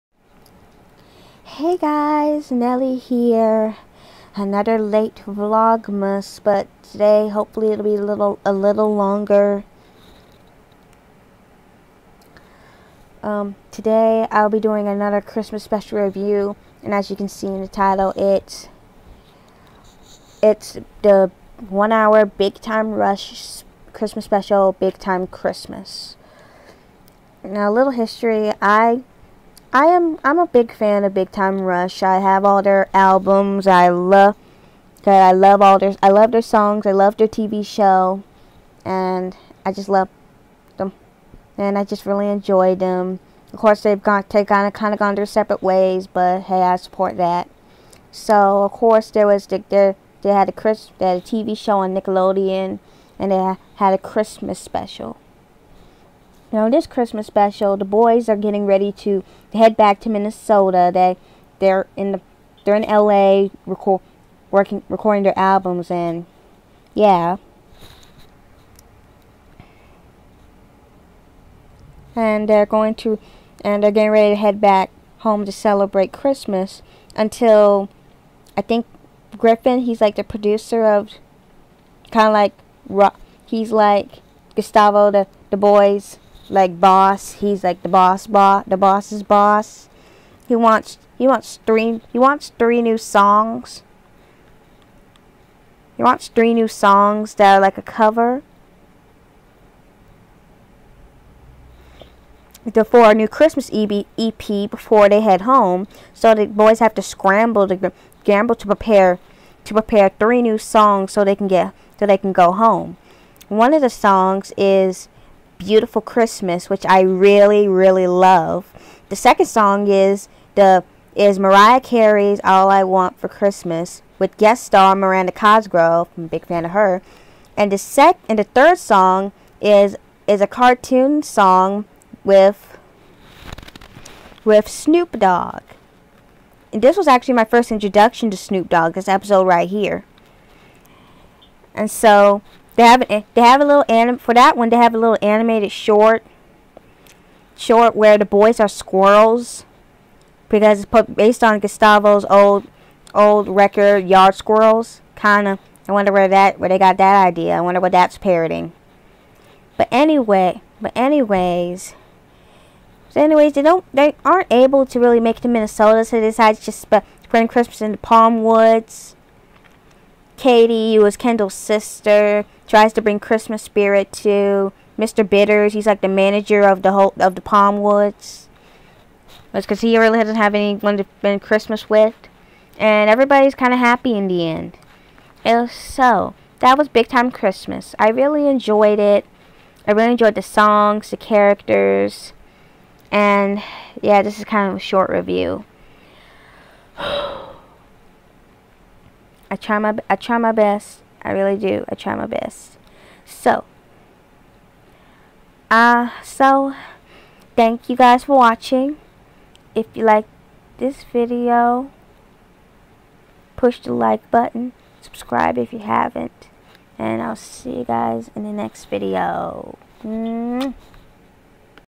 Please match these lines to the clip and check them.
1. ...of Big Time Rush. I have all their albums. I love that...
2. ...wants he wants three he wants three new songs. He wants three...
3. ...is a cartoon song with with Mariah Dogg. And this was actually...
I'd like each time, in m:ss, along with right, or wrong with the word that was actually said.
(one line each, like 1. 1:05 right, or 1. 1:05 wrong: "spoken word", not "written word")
1. 0:31 right
2. 1:30 right
3. 2:10 wrong: "Snoop", not "Mariah".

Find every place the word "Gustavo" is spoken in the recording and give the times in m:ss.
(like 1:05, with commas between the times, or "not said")
1:24, 2:31.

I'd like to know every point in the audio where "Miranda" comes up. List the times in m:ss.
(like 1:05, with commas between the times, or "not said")
2:04.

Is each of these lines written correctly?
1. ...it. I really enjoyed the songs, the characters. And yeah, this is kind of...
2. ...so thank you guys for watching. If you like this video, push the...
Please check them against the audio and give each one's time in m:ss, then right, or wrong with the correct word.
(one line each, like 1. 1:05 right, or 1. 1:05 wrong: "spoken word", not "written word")
1. 3:08 right
2. 3:26 right.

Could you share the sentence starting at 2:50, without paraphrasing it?
Katie, who is Kendall's sister, tries to bring Christmas spirit to Mr.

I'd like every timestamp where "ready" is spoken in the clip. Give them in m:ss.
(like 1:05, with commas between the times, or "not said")
0:58, 1:14.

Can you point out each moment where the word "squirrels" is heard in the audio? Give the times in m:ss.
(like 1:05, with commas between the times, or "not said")
2:28, 2:34.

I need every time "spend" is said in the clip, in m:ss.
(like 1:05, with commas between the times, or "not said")
2:46, 3:01.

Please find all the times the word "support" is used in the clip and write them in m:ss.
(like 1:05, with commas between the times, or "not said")
0:46.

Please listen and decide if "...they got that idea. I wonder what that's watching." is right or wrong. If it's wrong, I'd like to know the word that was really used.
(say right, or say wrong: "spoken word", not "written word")
wrong: "parroting", not "watching".